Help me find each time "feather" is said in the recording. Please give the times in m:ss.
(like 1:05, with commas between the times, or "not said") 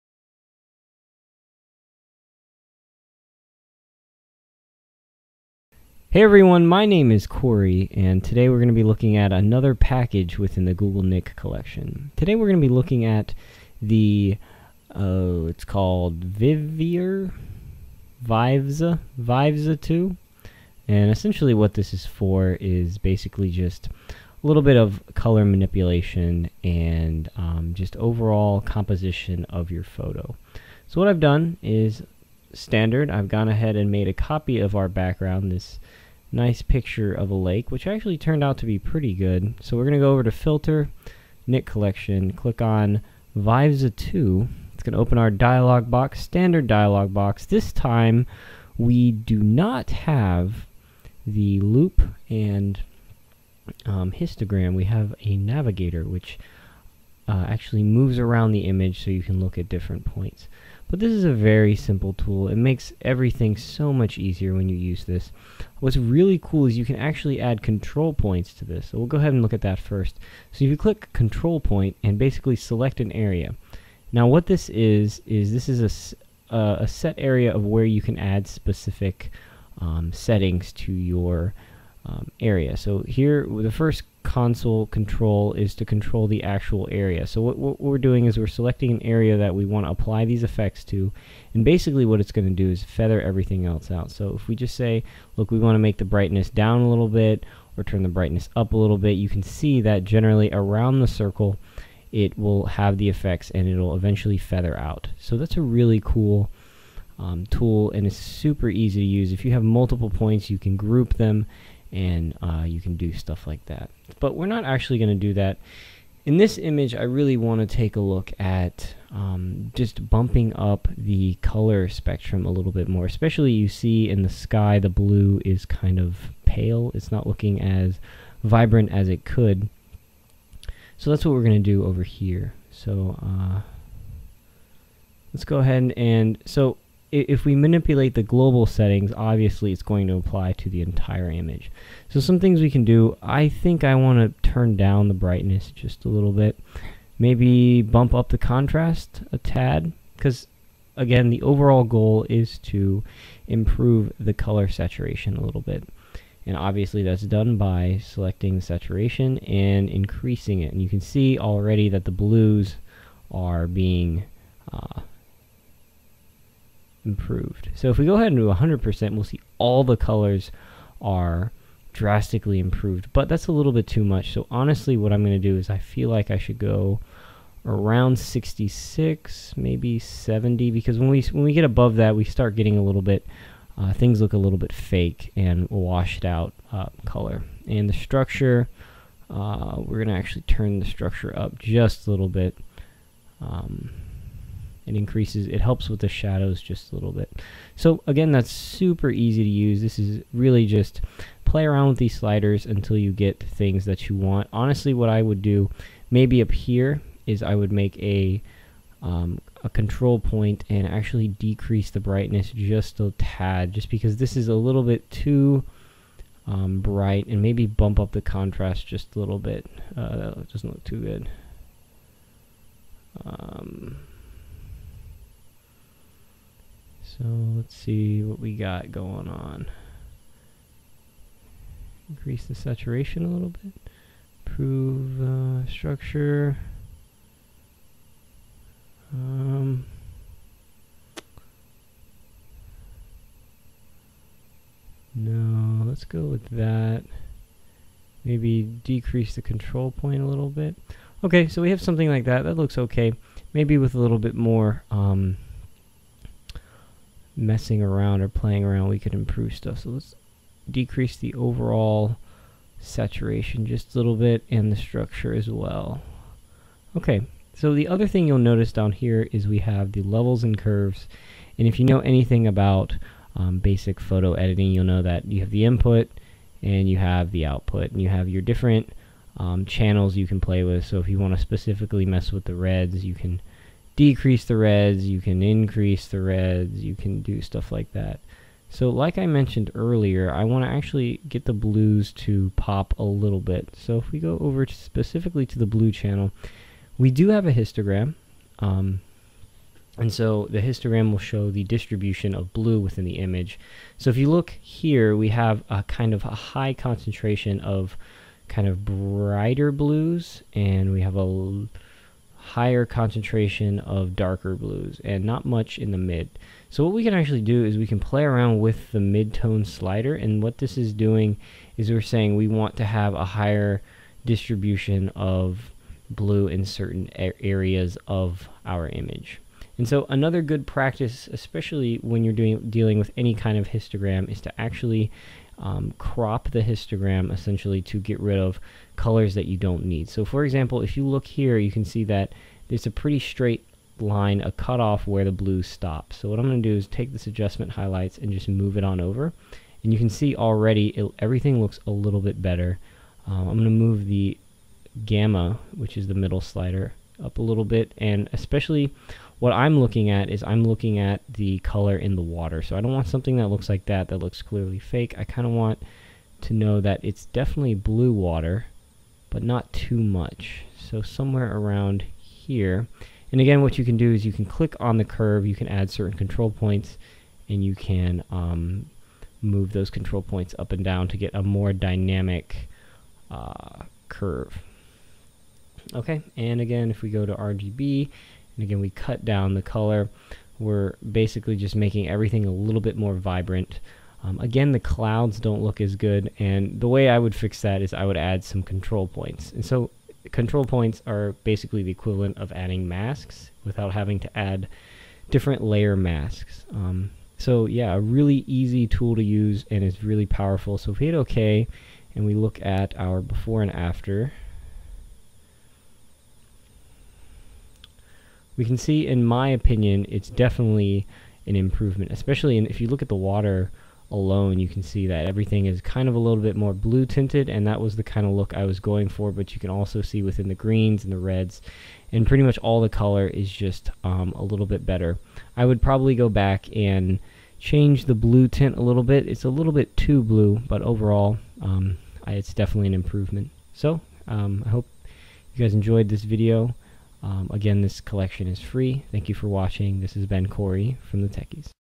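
1:32, 1:44.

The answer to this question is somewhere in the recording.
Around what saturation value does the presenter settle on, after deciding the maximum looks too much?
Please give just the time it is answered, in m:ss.
2:58.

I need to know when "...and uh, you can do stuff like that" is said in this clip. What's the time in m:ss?
1:51.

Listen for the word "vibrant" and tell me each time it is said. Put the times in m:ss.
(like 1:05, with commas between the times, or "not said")
2:08, 6:33.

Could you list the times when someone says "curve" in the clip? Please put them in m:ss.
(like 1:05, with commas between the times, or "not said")
4:30, 6:15, 6:24.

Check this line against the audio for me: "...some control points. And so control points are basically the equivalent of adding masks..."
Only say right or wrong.
right.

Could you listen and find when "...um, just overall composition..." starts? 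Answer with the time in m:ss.
0:27.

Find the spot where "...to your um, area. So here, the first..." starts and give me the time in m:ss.
1:20.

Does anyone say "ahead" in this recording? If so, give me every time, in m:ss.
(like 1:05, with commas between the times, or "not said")
0:33, 1:09, 2:15, 2:48.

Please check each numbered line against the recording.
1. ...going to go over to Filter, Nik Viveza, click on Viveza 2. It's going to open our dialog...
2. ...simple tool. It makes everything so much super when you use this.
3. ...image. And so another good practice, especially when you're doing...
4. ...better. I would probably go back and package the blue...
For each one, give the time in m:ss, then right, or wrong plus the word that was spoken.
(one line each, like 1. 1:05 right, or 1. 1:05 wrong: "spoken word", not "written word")
1. 0:39 wrong: "Collection", not "Viveza"
2. 1:01 wrong: "easier", not "super"
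3. 5:28 right
4. 7:14 wrong: "change", not "package".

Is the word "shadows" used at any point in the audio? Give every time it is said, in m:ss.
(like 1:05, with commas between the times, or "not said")
3:16.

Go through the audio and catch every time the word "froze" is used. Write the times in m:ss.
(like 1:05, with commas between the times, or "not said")
not said.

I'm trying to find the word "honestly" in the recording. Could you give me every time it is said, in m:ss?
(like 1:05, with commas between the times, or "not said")
2:54, 3:24.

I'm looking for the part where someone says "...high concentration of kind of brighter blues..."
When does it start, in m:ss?
5:06.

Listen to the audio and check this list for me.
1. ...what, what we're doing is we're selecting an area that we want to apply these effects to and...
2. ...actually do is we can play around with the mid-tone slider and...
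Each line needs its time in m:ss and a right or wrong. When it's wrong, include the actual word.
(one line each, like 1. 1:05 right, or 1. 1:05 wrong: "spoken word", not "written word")
1. 1:27 right
2. 5:17 right.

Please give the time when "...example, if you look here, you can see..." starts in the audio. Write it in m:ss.
5:40.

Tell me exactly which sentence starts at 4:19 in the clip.
So let's decrease the overall saturation just a little bit and the structure as well.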